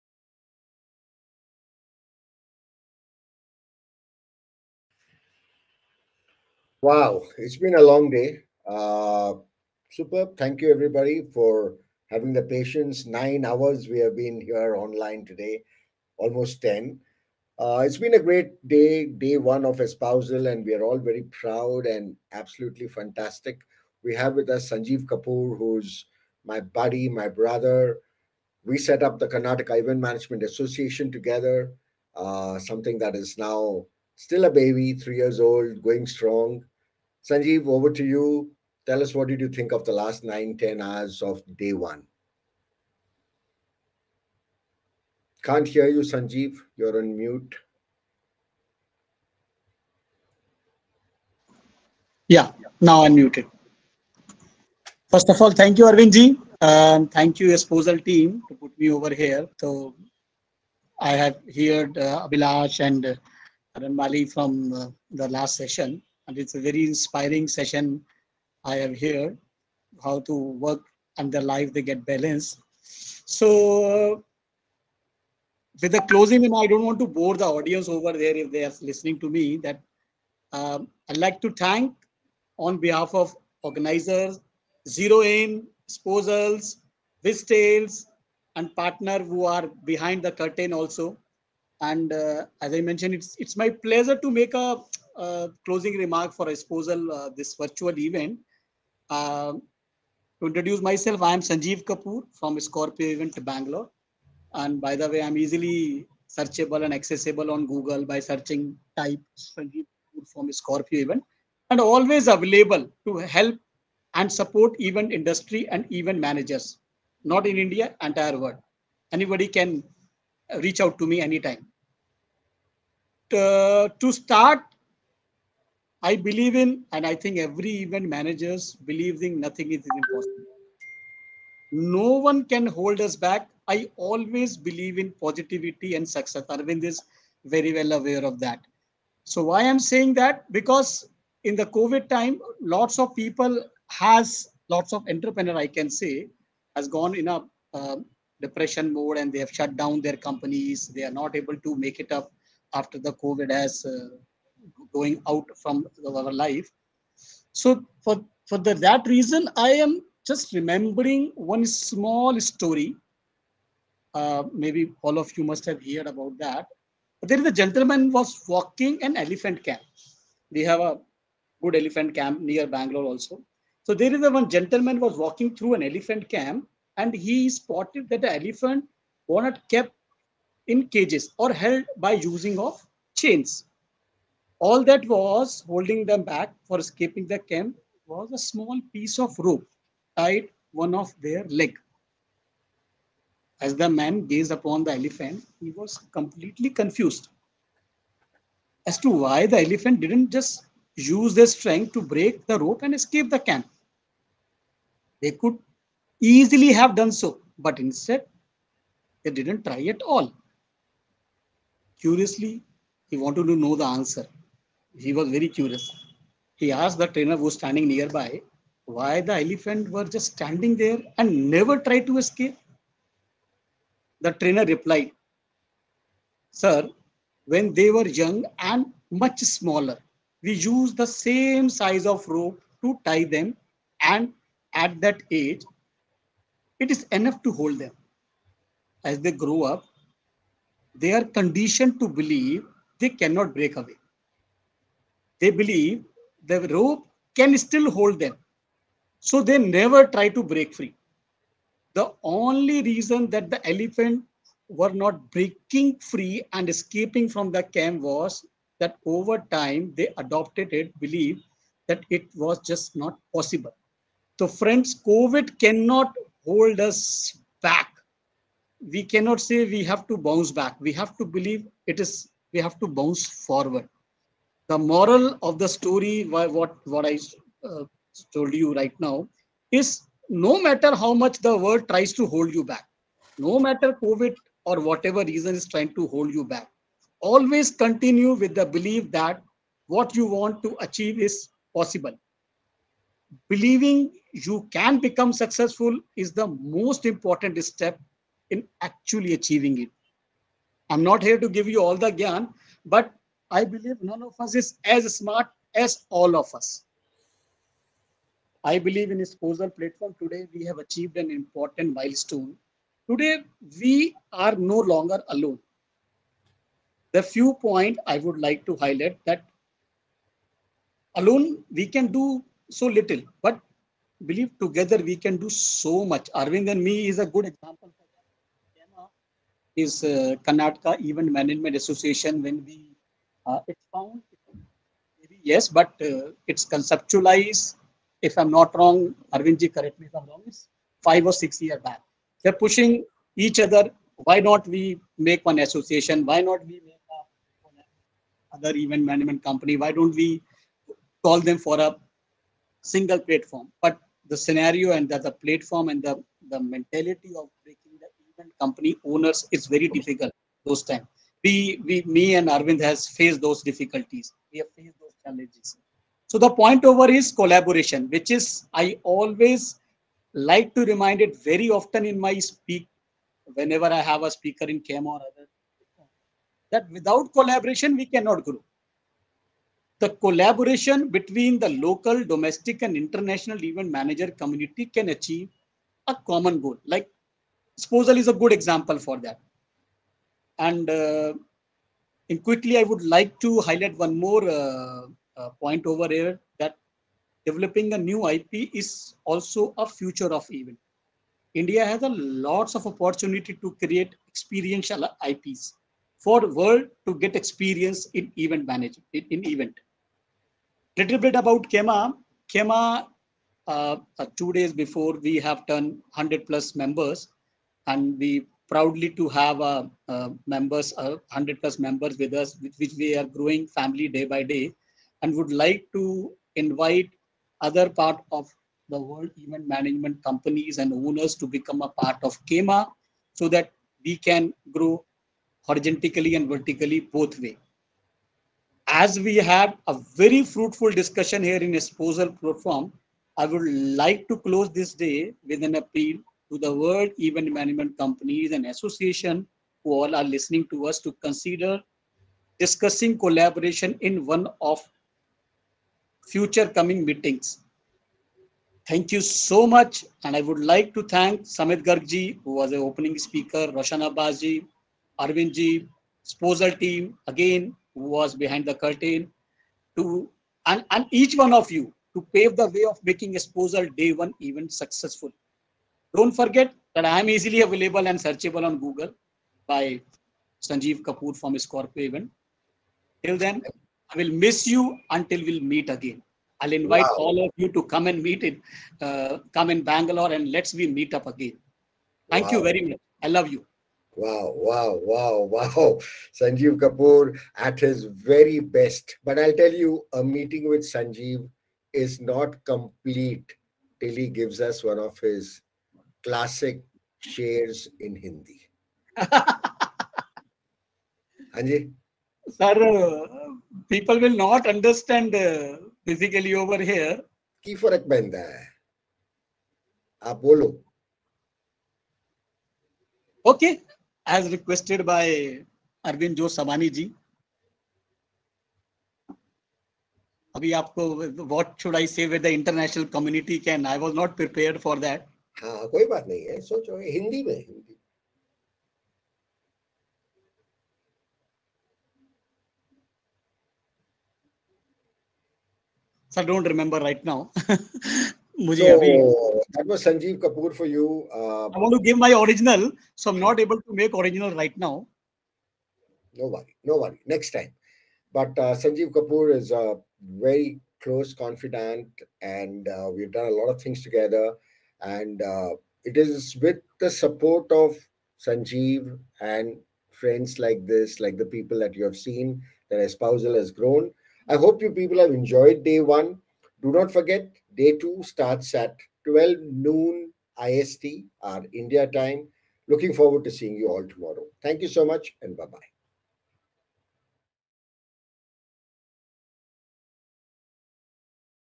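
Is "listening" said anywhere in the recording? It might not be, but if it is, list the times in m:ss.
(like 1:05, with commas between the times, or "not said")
1:18, 7:30.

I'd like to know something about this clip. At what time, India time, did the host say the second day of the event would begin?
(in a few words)
12 noon IST.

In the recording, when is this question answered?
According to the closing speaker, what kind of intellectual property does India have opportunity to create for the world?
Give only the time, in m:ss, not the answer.
6:44.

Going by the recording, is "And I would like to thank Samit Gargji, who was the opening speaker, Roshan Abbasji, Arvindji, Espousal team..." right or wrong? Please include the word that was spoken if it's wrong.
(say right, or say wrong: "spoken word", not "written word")
right.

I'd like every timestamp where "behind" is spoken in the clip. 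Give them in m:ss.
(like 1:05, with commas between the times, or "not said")
1:29, 7:48.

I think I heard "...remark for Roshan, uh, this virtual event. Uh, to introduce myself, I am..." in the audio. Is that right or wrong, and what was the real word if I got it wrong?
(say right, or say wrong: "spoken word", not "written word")
wrong: "Espousal", not "Roshan".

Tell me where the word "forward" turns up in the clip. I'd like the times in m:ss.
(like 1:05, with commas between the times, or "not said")
4:33, 9:43.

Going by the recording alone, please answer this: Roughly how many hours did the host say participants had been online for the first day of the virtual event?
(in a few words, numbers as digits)
9.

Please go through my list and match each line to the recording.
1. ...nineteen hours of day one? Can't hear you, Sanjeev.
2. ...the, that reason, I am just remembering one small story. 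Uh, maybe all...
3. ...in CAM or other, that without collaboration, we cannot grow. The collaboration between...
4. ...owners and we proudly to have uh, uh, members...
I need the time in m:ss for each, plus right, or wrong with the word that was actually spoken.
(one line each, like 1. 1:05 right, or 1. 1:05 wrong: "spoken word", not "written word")
1. 0:40 wrong: "ten", not "nineteen"
2. 2:38 right
3. 6:14 right
4. 6:56 wrong: "members", not "owners".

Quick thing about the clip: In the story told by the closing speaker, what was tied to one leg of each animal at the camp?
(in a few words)
a small piece of rope.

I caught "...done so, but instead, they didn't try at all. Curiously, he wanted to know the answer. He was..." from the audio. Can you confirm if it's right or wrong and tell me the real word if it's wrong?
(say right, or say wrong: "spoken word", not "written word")
right.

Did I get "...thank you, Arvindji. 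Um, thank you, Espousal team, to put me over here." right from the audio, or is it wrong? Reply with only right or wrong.
right.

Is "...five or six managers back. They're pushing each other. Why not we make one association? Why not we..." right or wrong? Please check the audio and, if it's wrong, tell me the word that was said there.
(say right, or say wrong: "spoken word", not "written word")
wrong: "years", not "managers".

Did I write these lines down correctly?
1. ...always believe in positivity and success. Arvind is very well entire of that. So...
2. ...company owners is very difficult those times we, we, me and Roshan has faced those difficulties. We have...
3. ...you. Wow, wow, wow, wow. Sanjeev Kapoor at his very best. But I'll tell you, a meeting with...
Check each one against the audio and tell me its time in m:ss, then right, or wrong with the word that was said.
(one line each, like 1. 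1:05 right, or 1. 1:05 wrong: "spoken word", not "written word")
1. 2:13 wrong: "aware", not "entire"
2. 5:58 wrong: "Arvind", not "Roshan"
3. 8:13 right.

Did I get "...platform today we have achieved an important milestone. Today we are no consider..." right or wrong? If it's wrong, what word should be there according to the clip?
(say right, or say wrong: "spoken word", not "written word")
wrong: "longer", not "consider".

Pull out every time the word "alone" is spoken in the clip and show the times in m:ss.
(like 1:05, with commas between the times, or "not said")
5:15, 5:21.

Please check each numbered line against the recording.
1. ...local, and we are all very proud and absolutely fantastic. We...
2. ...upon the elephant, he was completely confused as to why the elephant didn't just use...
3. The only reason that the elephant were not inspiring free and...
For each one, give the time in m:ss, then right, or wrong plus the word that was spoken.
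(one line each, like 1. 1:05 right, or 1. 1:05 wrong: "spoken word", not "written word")
1. 0:19 wrong: "espousal", not "local"
2. 3:14 right
3. 4:11 wrong: "breaking", not "inspiring".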